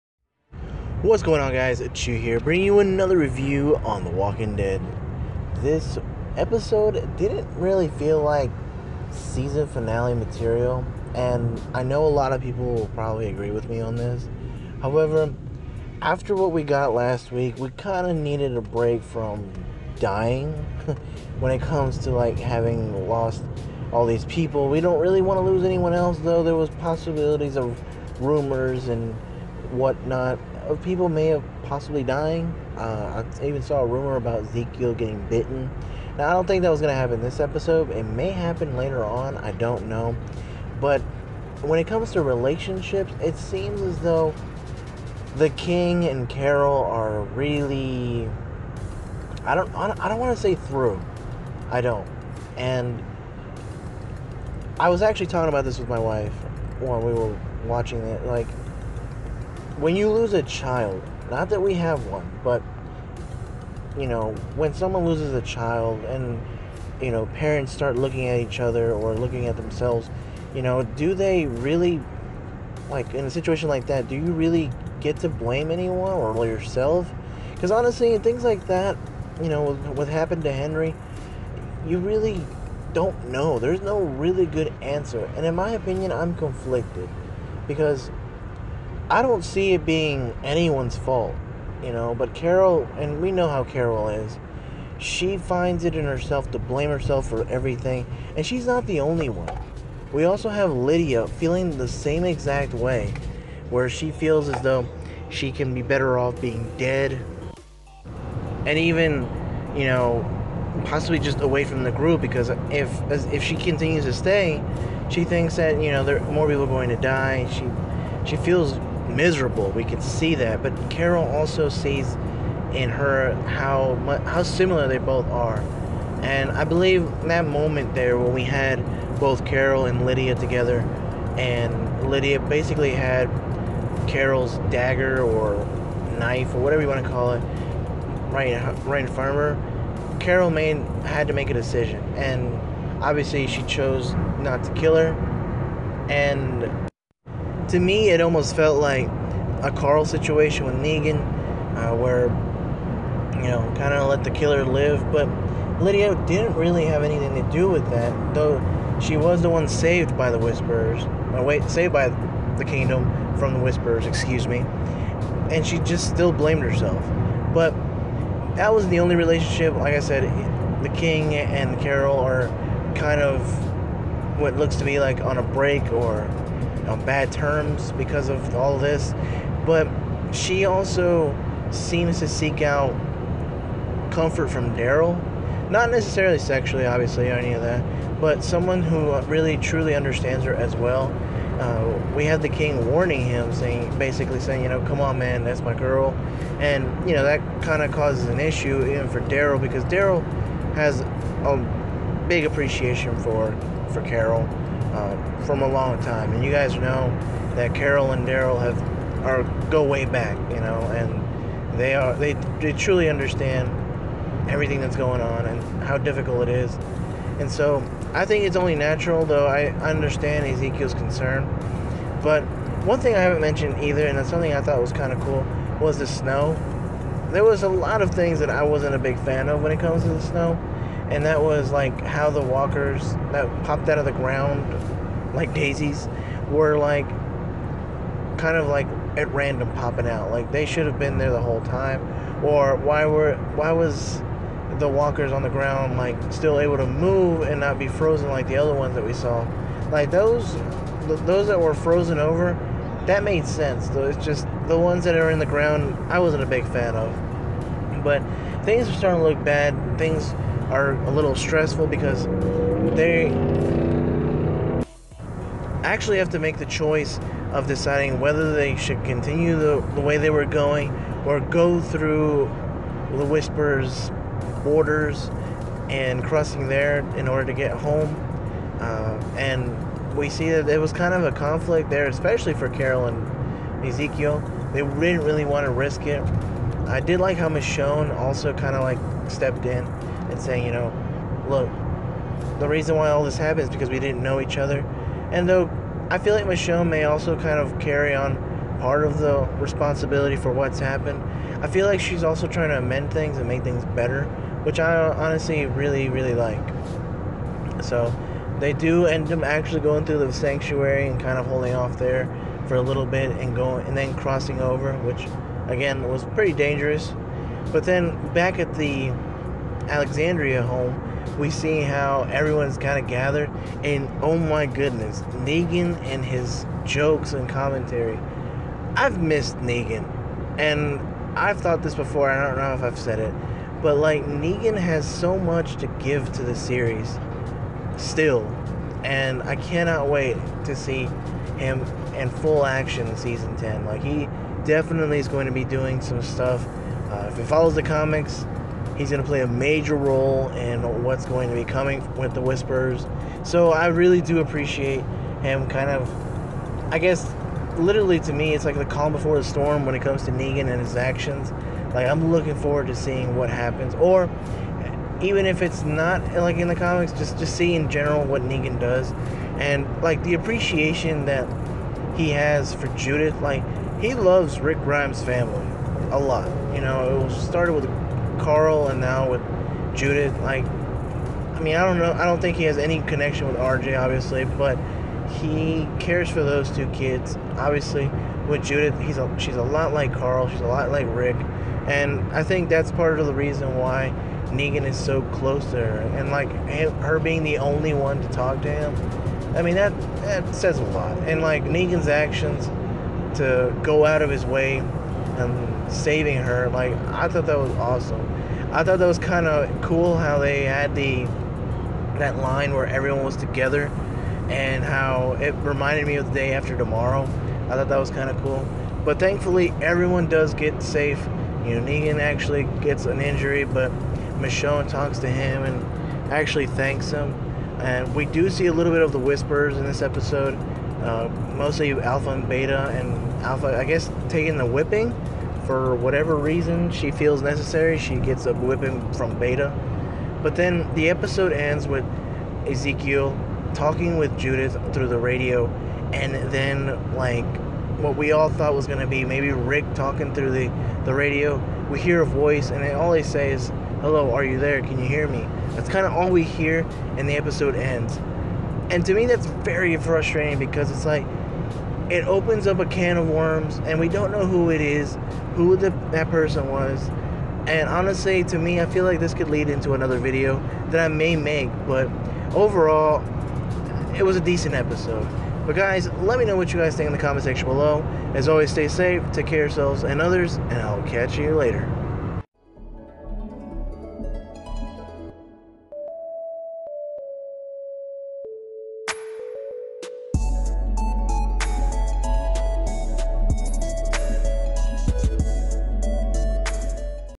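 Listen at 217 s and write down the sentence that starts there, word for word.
And so I think it's only natural, though I understand Ezekiel's concern.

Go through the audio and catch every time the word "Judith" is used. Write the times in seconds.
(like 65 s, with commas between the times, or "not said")
372 s, 379 s, 388 s, 444 s.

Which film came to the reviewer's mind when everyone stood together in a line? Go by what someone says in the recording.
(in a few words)
The Day After Tomorrow.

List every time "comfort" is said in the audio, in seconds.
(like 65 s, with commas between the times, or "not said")
184 s.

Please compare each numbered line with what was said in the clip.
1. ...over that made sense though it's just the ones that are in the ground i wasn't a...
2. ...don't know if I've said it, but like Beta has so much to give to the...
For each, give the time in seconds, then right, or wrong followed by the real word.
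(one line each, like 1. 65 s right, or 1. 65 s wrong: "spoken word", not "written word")
1. 252 s right
2. 332 s wrong: "Negan", not "Beta".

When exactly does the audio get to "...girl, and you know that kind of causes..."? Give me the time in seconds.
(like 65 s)
195 s.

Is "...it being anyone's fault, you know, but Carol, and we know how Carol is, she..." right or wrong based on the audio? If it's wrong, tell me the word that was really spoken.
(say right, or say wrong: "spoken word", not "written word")
right.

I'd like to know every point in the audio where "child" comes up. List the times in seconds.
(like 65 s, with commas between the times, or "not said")
60 s, 65 s.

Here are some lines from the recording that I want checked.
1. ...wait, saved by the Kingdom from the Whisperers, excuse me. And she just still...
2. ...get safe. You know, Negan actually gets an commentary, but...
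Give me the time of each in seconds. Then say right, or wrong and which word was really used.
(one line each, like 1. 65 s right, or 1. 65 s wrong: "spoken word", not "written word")
1. 161 s right
2. 420 s wrong: "injury", not "commentary".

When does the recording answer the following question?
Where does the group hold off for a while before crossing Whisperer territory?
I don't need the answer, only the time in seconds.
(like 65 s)
310 s.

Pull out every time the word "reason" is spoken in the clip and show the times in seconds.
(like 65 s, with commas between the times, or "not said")
292 s, 393 s, 436 s.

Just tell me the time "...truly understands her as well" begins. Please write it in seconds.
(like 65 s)
189 s.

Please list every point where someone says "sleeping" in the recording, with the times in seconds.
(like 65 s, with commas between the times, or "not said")
not said.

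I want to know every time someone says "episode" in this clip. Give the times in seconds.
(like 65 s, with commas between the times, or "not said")
6 s, 37 s, 430 s, 441 s, 457 s, 474 s.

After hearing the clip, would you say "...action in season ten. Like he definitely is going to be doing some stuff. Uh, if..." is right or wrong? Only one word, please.
right.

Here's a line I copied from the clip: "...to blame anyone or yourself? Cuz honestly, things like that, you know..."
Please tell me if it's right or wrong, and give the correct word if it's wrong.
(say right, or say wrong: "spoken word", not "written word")
right.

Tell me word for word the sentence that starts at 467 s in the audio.
And honestly, to me, I feel like this could lead into another video that I may make.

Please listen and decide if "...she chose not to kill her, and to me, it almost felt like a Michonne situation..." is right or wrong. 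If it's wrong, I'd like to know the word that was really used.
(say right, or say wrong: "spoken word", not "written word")
wrong: "Carl", not "Michonne".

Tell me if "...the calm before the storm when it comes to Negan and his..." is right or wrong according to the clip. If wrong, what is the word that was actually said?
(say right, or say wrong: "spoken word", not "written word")
right.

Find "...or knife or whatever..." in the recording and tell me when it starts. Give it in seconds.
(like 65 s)
135 s.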